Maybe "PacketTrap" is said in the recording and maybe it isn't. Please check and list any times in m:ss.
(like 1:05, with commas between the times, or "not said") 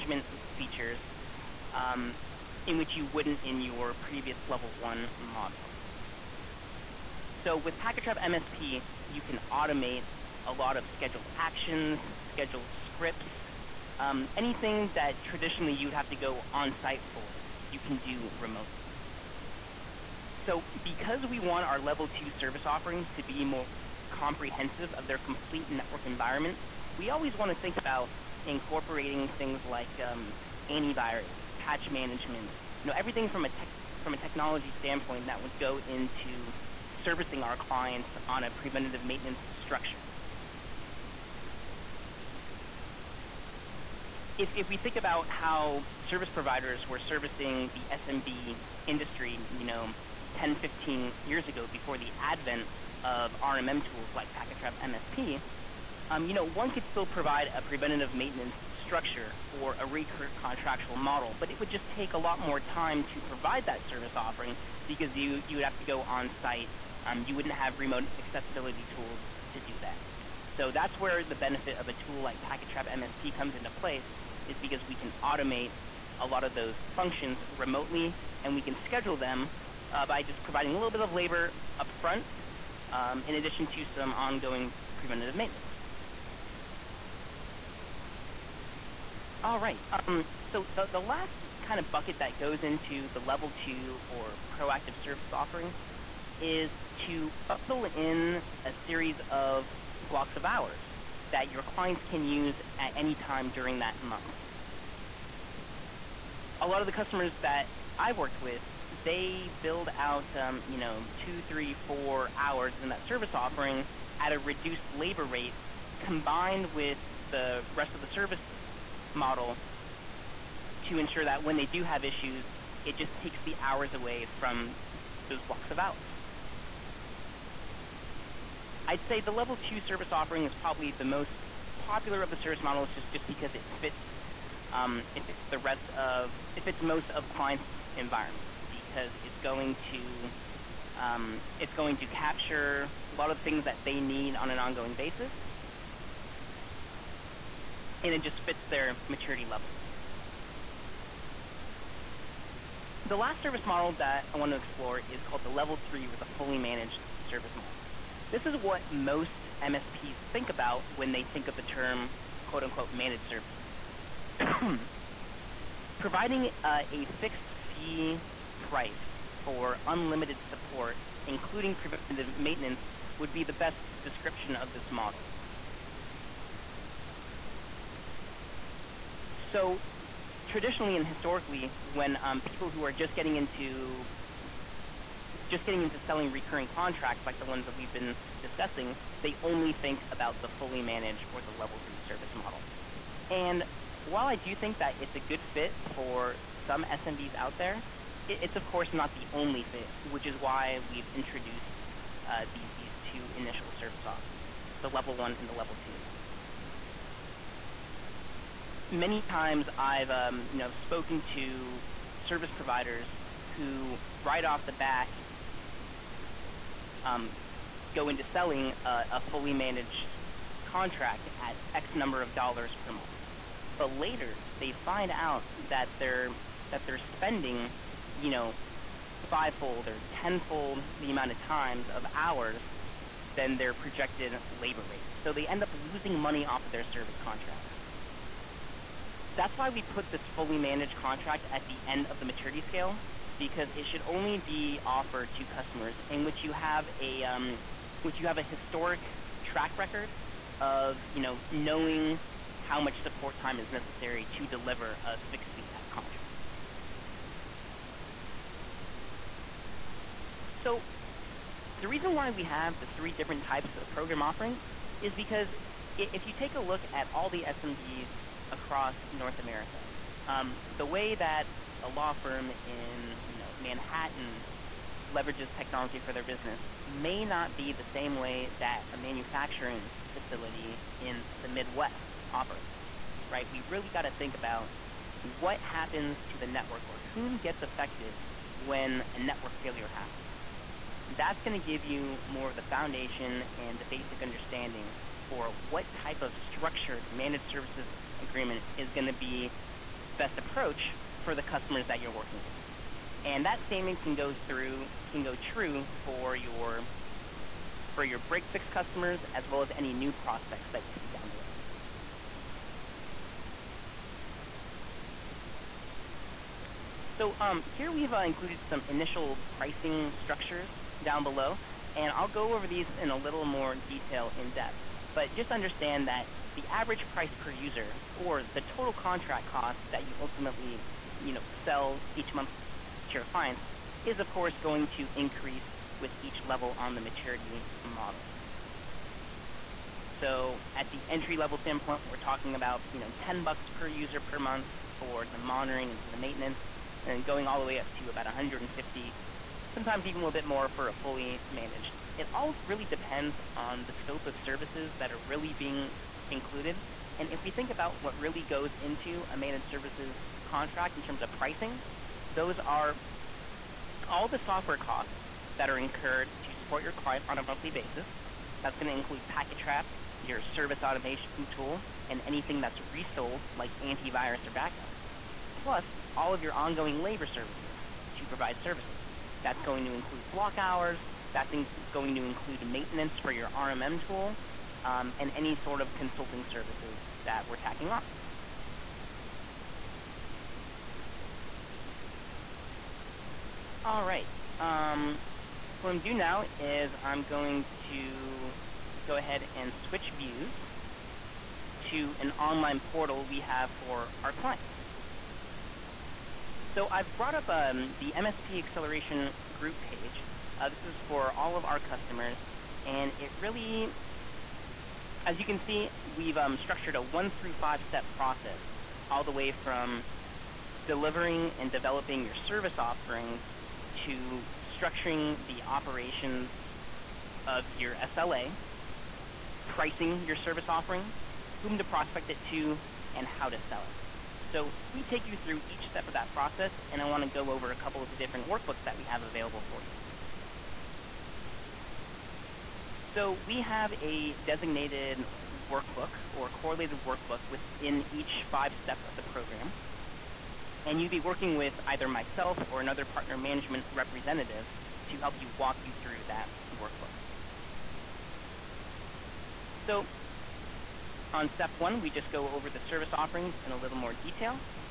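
0:07, 0:54, 1:12, 6:09.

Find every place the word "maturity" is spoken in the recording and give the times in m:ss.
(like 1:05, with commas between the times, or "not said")
2:29, 4:02, 5:37.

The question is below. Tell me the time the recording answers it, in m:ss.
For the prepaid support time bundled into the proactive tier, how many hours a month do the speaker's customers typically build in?
1:51.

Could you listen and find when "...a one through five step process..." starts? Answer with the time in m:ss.
6:56.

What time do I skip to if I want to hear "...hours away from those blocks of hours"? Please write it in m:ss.
2:03.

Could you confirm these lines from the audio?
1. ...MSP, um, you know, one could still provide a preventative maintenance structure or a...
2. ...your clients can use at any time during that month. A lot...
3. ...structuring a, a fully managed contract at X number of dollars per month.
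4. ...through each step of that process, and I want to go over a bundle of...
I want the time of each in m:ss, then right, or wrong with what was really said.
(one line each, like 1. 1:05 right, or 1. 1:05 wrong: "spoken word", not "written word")
1. 0:54 right
2. 1:41 right
3. 3:38 wrong: "selling", not "structuring"
4. 7:15 wrong: "couple", not "bundle".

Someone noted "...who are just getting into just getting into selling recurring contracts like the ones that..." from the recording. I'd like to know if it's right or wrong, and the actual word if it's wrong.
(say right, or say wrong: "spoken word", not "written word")
right.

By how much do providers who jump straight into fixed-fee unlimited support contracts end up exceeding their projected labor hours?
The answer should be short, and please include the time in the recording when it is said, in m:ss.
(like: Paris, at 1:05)
fivefold or tenfold, at 3:49.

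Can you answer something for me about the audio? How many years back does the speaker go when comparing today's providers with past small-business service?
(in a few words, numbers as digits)
10, 15 years.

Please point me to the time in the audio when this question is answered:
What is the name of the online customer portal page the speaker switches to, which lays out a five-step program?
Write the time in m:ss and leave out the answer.
6:48.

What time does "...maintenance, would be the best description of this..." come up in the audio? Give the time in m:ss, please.
2:52.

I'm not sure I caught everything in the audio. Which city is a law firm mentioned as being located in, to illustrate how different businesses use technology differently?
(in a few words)
Manhattan.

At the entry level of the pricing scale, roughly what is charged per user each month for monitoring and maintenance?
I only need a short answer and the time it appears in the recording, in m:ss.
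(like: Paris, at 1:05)
$10, at 5:43.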